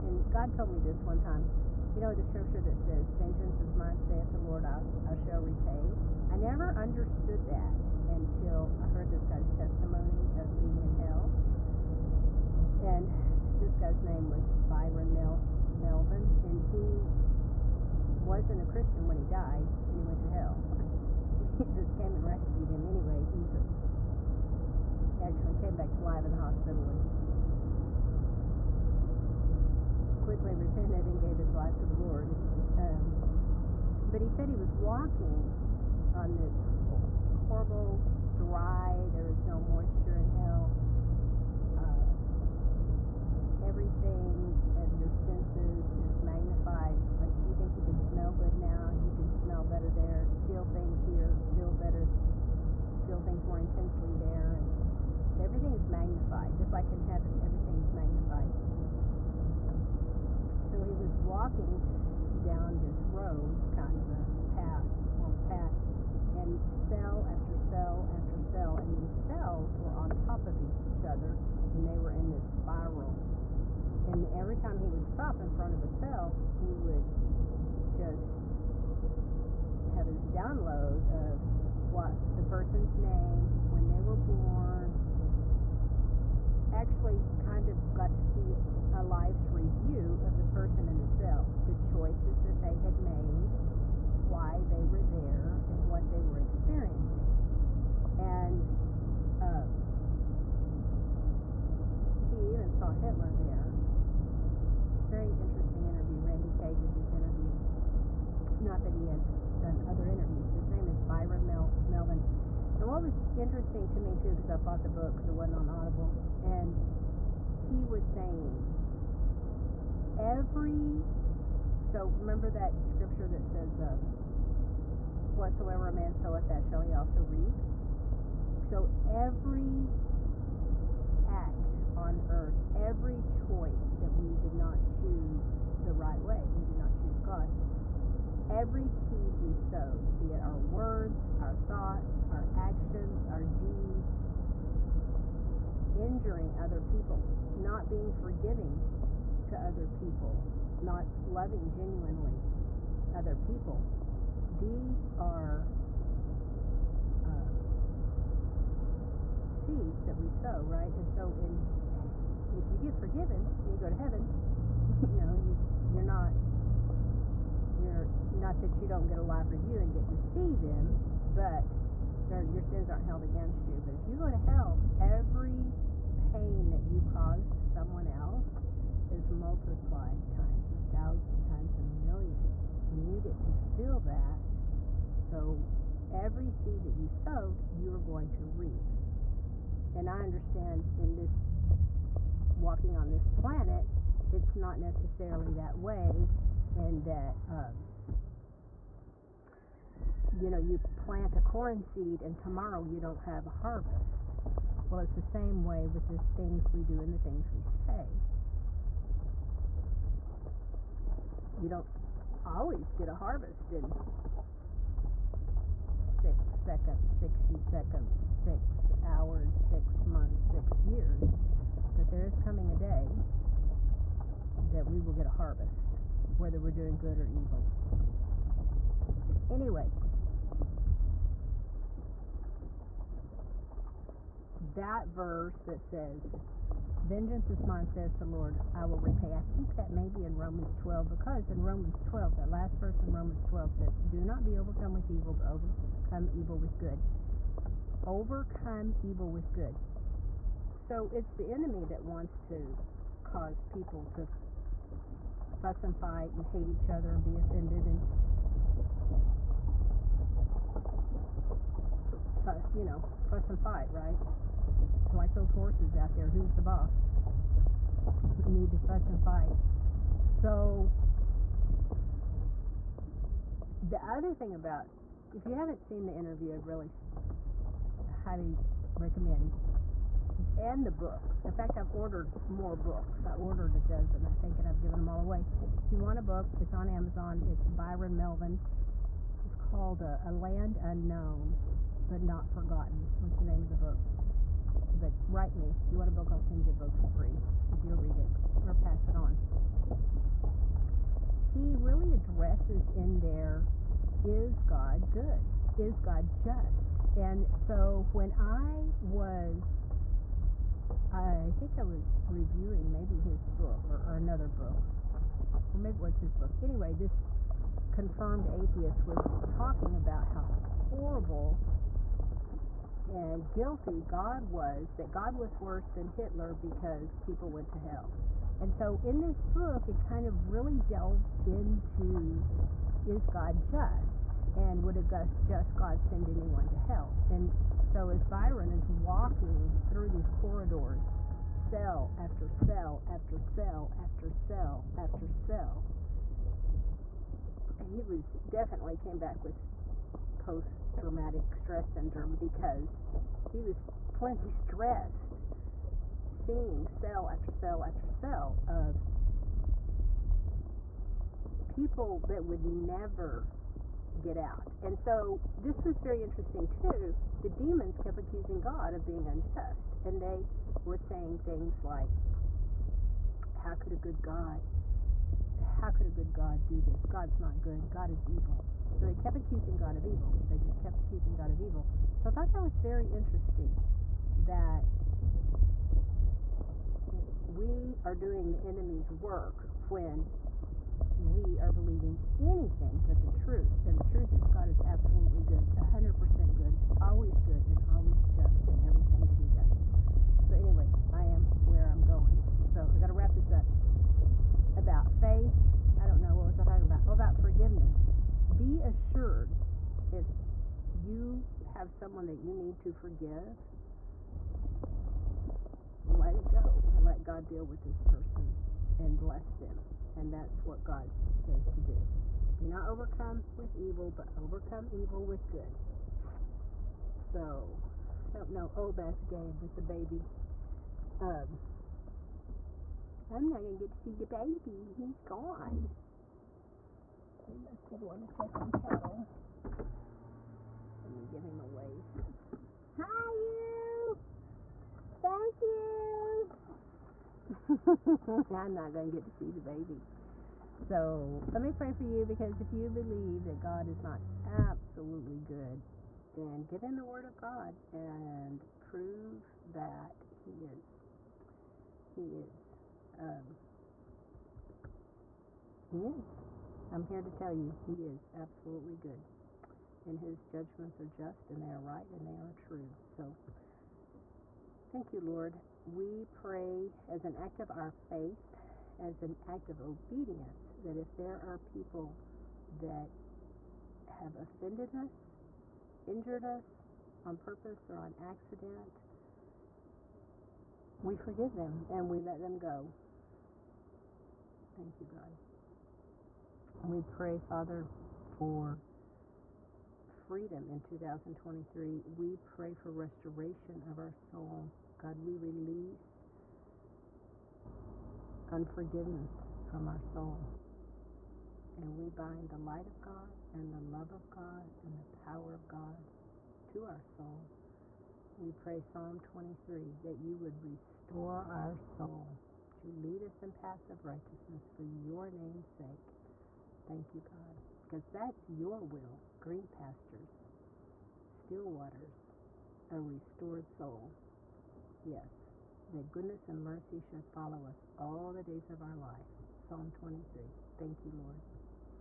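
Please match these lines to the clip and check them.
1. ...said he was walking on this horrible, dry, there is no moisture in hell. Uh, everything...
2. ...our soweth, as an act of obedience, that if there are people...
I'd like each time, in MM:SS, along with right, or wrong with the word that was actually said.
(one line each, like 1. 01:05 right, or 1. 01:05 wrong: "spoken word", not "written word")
1. 00:34 right
2. 07:57 wrong: "faith", not "soweth".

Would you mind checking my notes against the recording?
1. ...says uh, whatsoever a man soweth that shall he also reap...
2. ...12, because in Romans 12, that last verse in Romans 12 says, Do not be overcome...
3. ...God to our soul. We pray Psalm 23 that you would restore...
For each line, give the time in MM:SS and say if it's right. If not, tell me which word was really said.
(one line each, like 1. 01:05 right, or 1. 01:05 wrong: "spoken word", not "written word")
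1. 02:03 right
2. 04:00 right
3. 08:35 right.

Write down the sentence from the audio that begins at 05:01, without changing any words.
He really addresses in there, is God good?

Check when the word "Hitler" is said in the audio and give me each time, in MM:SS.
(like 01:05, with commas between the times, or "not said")
01:42, 05:26.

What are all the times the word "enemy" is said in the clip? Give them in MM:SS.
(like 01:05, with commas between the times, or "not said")
04:11, 06:28.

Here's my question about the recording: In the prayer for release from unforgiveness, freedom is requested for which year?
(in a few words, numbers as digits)
2023.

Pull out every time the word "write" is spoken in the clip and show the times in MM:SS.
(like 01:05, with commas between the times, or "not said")
04:55.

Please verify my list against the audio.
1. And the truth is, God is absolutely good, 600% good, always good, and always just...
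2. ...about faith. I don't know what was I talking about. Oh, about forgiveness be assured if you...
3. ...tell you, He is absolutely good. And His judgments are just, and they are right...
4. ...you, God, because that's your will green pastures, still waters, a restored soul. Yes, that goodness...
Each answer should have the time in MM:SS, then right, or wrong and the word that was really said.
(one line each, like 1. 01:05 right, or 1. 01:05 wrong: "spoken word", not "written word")
1. 06:33 wrong: "100", not "600"
2. 06:44 right
3. 07:47 right
4. 08:47 right.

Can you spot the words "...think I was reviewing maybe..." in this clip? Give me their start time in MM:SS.
05:11.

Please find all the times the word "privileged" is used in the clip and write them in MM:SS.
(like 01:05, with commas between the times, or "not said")
not said.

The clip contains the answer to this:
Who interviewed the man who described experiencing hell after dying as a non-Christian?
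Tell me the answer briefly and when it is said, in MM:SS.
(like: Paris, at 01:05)
Randy Kay, at 01:46.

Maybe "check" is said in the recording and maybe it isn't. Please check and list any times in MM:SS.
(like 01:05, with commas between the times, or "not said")
07:18.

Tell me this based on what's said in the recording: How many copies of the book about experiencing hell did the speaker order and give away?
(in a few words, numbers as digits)
a dozen.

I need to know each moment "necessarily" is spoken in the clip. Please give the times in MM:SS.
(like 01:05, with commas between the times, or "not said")
03:14.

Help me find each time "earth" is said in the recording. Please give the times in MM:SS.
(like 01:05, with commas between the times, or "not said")
02:12.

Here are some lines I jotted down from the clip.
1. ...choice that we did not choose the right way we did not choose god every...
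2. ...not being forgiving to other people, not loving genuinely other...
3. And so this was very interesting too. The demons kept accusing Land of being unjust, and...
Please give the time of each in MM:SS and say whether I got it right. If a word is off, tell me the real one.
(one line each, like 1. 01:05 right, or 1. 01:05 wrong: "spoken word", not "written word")
1. 02:13 right
2. 02:27 right
3. 06:04 wrong: "God", not "Land".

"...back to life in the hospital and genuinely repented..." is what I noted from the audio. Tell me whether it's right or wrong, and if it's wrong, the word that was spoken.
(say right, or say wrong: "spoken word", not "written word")
wrong: "quickly", not "genuinely".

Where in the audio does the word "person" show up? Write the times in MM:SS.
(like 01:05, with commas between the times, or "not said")
01:22, 01:30, 06:58.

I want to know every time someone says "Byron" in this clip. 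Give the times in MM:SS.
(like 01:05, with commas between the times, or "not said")
00:14, 01:51, 04:47, 05:38.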